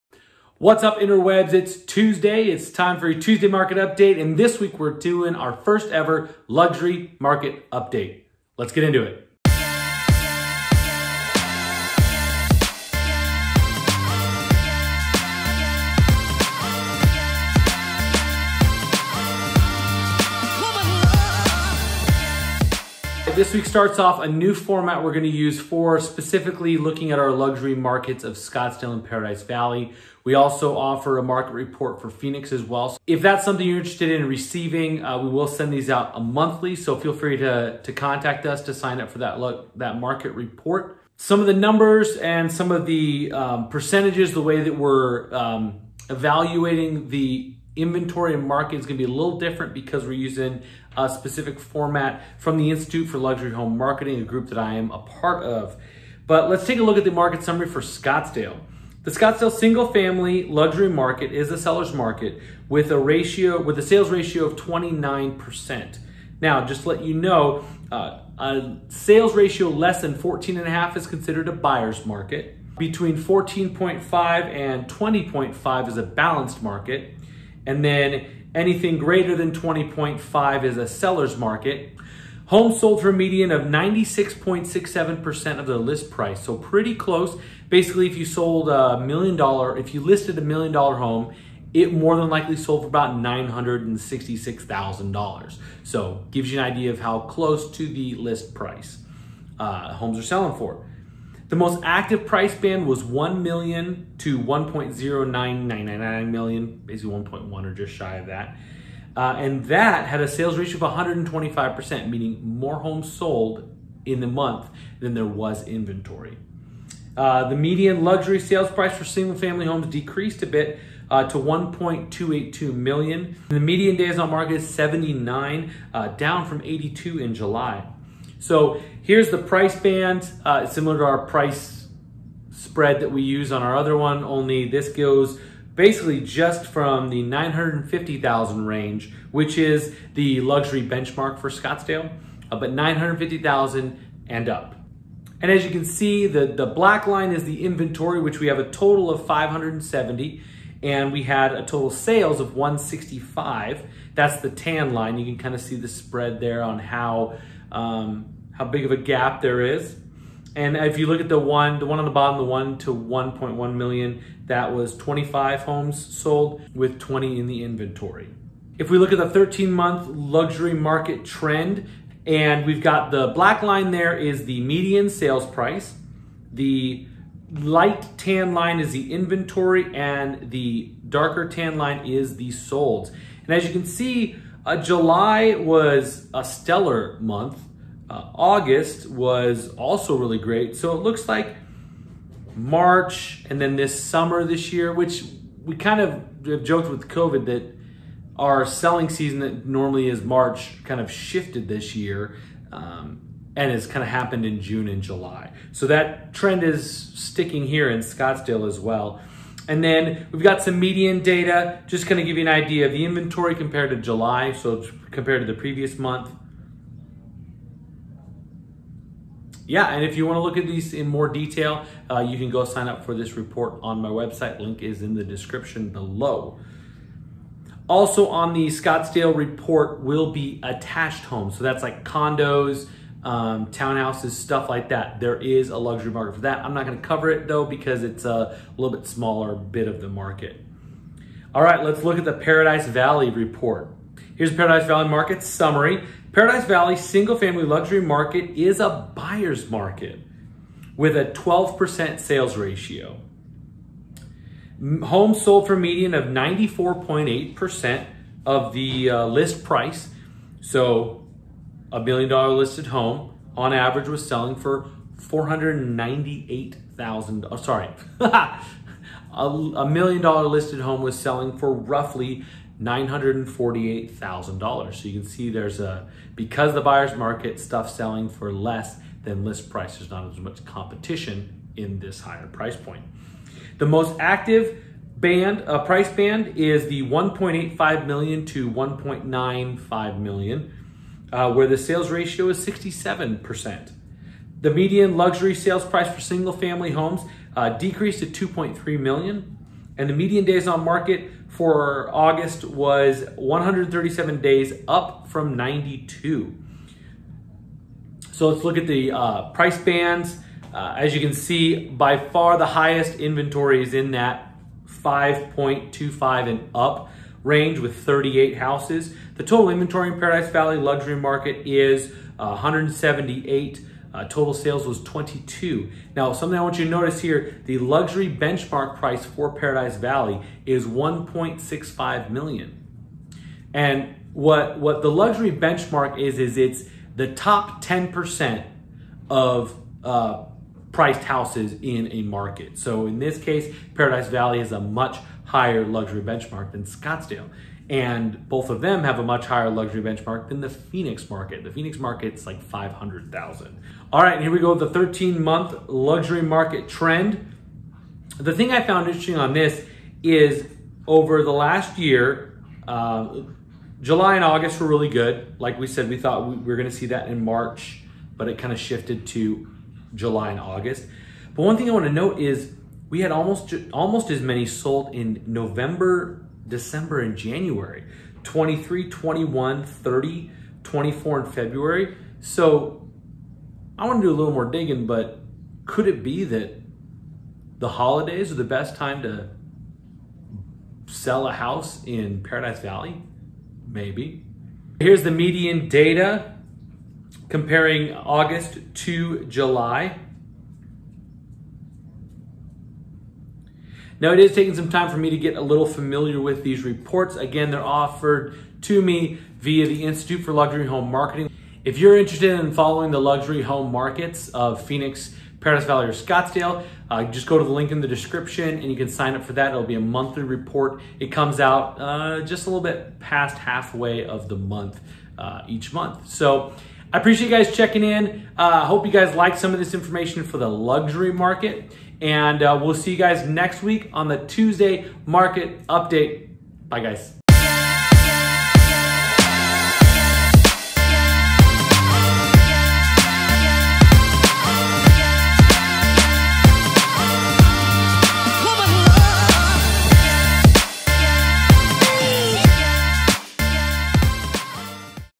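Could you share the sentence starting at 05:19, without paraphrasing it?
The total inventory in Paradise Valley luxury market is uh, 178.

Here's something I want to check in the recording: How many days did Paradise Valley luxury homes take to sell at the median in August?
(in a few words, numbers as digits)
137.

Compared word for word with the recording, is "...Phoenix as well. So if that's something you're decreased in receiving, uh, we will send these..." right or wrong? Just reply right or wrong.
wrong.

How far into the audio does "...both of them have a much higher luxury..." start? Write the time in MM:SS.
05:48.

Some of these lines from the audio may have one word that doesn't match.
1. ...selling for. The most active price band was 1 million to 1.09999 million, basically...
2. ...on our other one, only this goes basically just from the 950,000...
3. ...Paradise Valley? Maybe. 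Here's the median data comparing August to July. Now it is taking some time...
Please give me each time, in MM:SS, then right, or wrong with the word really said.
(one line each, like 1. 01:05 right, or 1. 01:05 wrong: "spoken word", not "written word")
1. 01:40 right
2. 02:13 right
3. 06:32 right.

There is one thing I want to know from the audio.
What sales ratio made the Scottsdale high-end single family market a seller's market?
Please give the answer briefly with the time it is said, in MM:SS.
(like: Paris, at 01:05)
29%, at 01:04.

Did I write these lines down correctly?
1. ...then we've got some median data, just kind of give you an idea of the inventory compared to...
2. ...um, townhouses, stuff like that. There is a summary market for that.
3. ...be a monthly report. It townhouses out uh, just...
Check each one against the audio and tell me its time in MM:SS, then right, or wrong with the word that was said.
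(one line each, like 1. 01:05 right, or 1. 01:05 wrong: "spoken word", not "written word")
1. 03:29 right
2. 03:53 wrong: "luxury", not "summary"
3. 06:59 wrong: "comes", not "townhouses".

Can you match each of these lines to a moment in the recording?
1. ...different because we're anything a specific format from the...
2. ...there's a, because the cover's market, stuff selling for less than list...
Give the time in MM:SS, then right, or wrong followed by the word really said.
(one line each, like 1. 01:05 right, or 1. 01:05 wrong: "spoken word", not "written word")
1. 00:49 wrong: "using", not "anything"
2. 04:35 wrong: "buyer", not "cover".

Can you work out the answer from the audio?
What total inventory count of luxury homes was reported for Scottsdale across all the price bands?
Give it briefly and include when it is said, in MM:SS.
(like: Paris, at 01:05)
570, at 02:29.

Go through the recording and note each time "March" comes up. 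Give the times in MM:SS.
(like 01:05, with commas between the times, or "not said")
03:12, 03:20, 06:07.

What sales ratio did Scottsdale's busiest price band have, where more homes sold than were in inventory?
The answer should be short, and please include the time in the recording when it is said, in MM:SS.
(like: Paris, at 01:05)
125%, at 01:50.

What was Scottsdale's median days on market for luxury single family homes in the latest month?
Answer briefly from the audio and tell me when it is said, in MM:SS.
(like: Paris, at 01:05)
79, at 02:04.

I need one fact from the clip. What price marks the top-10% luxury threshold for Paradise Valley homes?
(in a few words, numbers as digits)
1.65 million.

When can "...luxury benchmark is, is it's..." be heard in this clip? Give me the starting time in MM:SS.
05:35.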